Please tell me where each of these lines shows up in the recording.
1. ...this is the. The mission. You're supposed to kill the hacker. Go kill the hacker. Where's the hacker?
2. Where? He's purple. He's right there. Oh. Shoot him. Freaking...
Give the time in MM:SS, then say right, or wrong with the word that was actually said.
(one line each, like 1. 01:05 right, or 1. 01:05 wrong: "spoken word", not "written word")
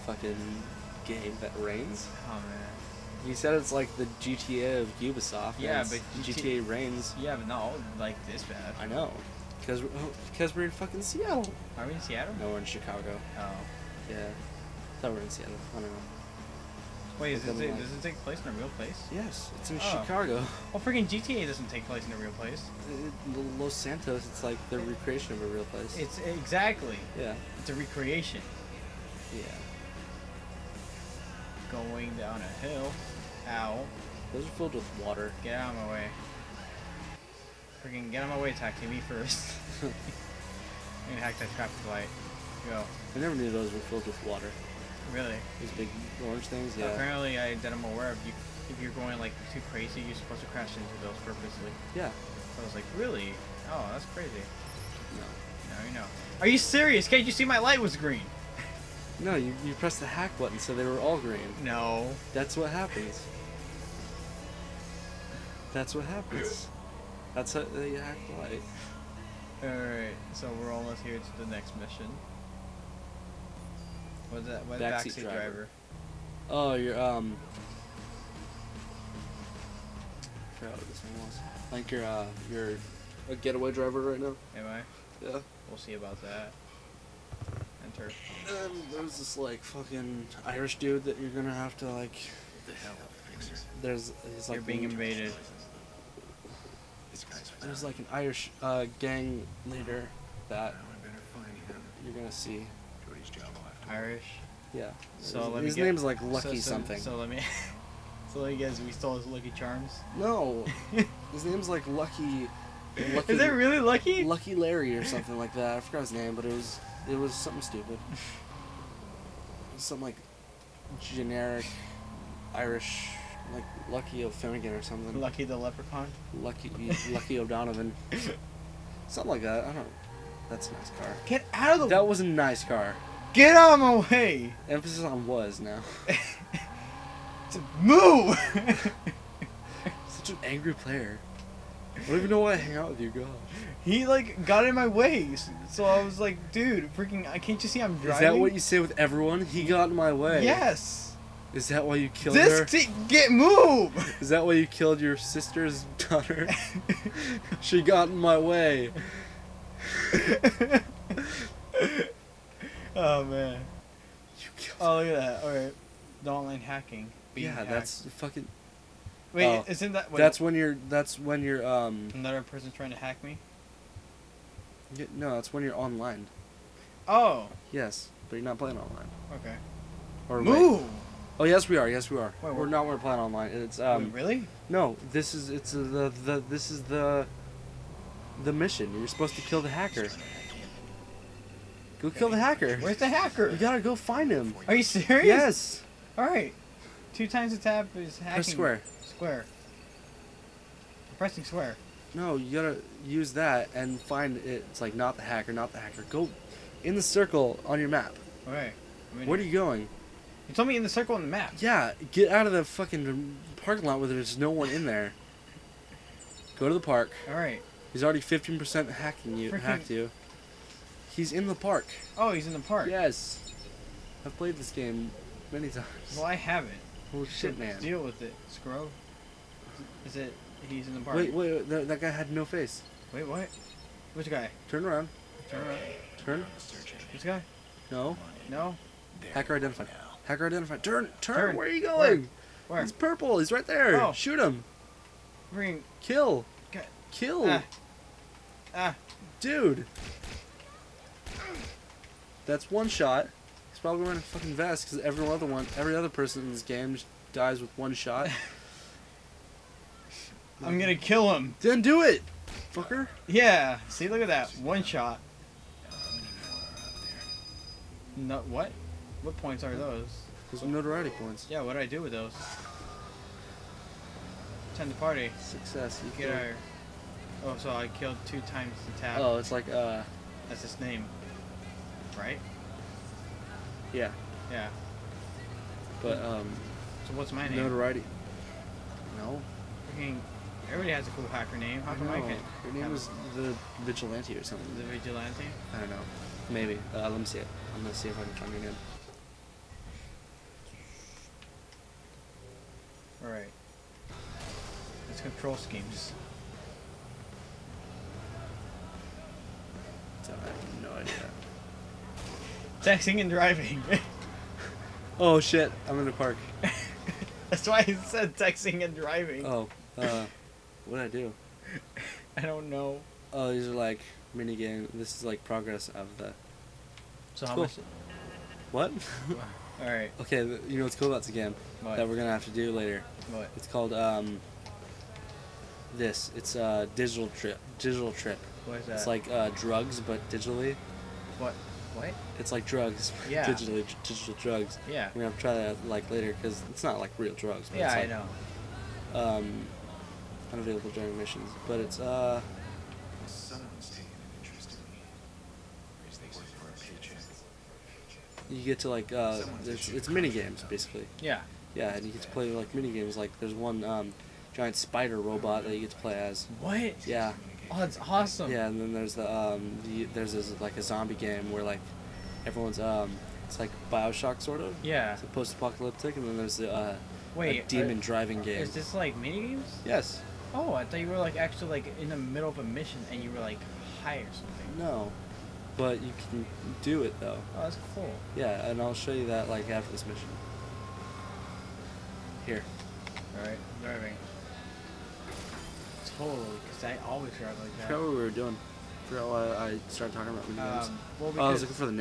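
1. 03:06 right
2. 04:02 right.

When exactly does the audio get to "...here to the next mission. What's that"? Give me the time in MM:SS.
01:11.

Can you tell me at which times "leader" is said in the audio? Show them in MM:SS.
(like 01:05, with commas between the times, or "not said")
01:39.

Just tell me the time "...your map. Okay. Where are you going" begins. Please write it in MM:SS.
03:27.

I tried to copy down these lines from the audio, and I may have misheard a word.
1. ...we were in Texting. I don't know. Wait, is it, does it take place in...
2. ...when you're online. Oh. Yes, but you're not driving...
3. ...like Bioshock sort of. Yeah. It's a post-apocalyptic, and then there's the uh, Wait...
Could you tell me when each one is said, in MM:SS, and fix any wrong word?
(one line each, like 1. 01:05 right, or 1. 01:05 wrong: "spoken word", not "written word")
1. 00:15 wrong: "Seattle", not "Texting"
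2. 02:55 wrong: "playing", not "driving"
3. 06:13 right.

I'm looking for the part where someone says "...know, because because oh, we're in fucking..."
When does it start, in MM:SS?
00:08.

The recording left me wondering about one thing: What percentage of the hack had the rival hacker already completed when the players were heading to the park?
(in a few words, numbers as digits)
15%.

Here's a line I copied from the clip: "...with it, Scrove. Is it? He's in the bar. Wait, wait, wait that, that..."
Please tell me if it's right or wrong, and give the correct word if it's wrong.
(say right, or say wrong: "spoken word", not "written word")
right.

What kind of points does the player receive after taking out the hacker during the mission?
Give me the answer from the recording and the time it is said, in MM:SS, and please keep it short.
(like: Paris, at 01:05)
Notoriety points, at 04:30.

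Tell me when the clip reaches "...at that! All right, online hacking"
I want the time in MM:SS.
02:45.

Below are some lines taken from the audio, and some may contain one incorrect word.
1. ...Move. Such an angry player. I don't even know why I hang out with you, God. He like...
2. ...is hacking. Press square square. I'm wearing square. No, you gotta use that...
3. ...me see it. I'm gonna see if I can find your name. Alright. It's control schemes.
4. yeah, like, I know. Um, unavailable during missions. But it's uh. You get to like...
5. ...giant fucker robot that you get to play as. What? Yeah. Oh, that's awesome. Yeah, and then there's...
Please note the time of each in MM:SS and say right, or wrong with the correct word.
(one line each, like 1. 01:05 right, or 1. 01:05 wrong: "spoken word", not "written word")
1. 02:17 right
2. 03:17 wrong: "pressing", not "wearing"
3. 04:57 right
4. 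05:47 right
5. 06:04 wrong: "spider", not "fucker".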